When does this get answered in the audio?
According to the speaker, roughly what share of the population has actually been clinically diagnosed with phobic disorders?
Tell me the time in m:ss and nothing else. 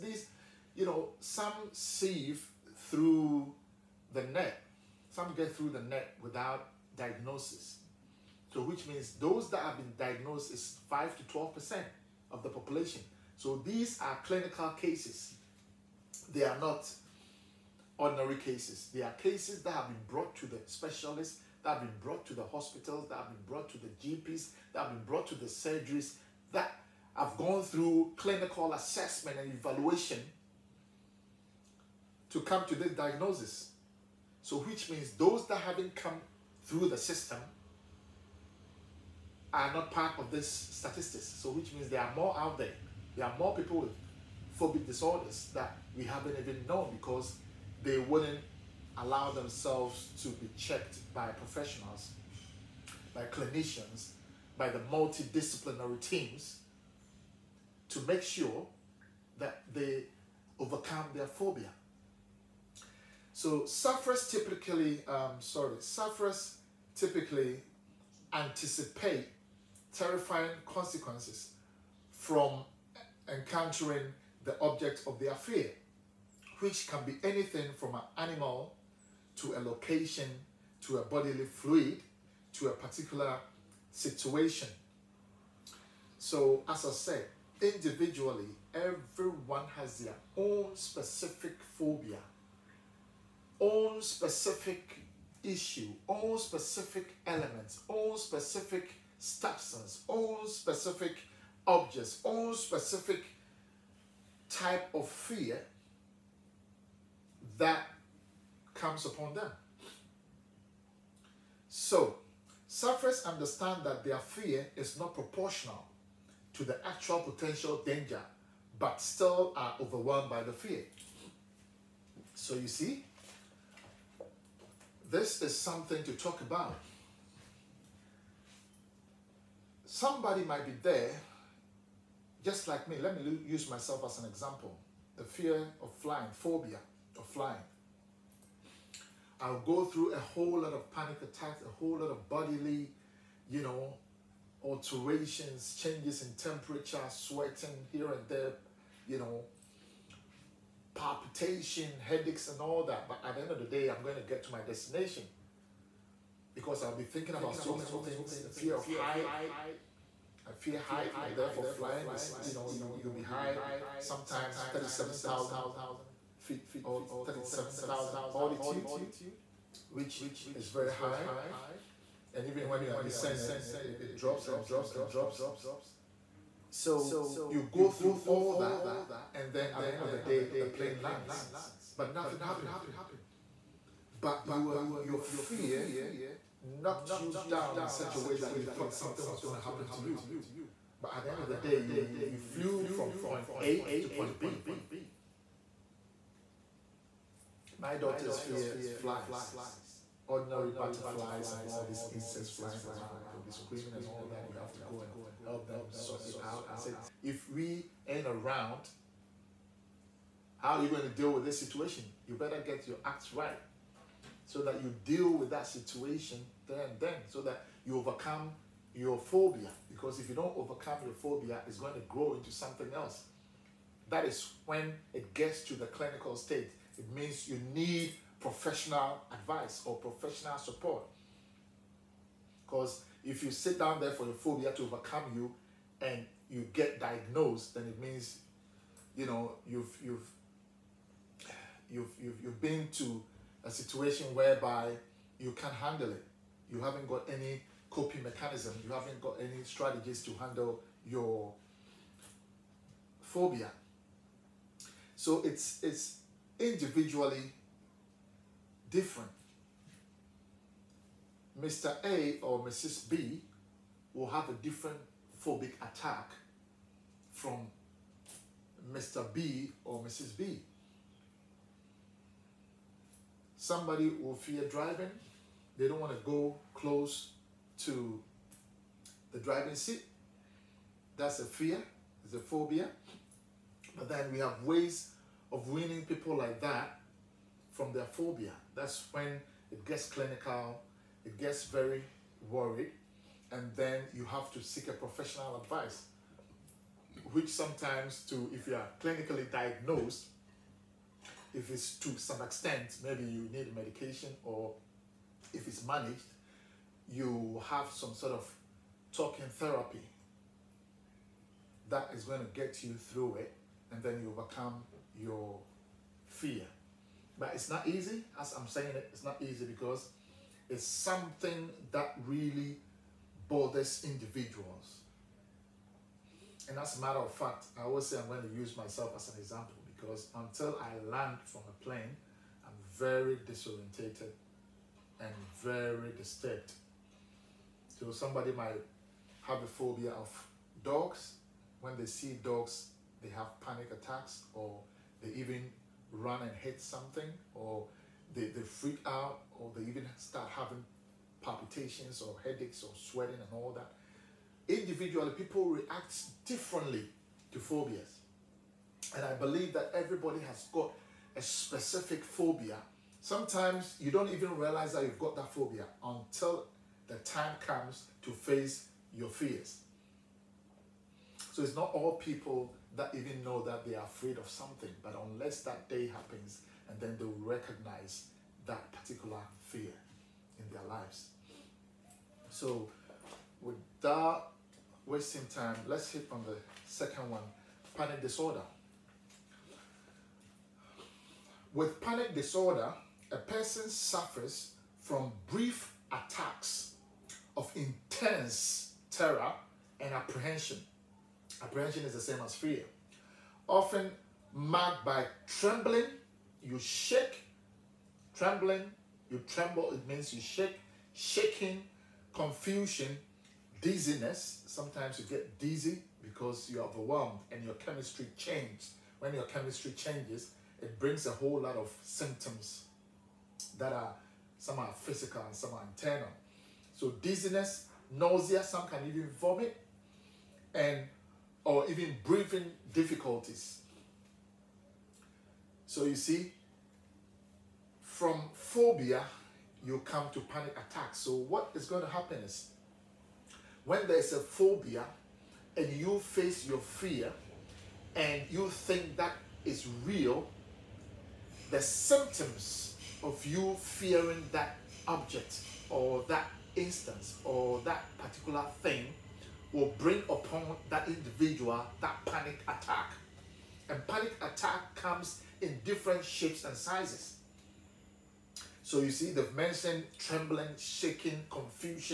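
0:10.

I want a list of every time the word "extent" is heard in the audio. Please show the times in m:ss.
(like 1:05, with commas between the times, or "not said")
5:02.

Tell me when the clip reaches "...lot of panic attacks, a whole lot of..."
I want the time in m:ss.
2:20.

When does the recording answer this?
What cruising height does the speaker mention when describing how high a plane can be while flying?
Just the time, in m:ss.
2:44.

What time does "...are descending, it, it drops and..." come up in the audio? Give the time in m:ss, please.
2:52.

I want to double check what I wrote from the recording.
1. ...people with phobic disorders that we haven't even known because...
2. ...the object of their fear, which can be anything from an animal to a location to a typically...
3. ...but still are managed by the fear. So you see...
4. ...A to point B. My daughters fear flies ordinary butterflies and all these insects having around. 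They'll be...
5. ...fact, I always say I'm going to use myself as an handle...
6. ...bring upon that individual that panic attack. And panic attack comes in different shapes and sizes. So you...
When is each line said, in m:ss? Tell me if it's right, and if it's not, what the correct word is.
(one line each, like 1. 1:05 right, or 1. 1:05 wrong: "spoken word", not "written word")
1. 0:43 right
2. 1:14 wrong: "bodily", not "typically"
3. 1:58 wrong: "overwhelmed", not "managed"
4. 3:13 wrong: "flying", not "having"
5. 5:27 wrong: "example", not "handle"
6. 7:39 right.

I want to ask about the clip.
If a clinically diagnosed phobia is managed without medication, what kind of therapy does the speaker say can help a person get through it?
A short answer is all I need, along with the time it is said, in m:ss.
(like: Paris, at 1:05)
talking therapy, at 5:09.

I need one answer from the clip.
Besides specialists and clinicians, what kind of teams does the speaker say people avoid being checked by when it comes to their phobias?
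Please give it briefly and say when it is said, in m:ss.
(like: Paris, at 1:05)
multidisciplinary teams, at 0:54.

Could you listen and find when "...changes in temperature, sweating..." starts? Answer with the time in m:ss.
2:25.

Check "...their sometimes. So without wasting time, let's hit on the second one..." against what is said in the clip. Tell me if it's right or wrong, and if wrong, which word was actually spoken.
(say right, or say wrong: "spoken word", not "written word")
wrong: "lives", not "sometimes".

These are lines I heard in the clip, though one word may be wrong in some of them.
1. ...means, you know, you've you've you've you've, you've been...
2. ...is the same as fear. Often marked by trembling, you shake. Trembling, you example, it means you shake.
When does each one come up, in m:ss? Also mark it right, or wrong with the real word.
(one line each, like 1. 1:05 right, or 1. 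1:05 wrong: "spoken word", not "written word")
1. 3:58 right
2. 6:42 wrong: "tremble", not "example".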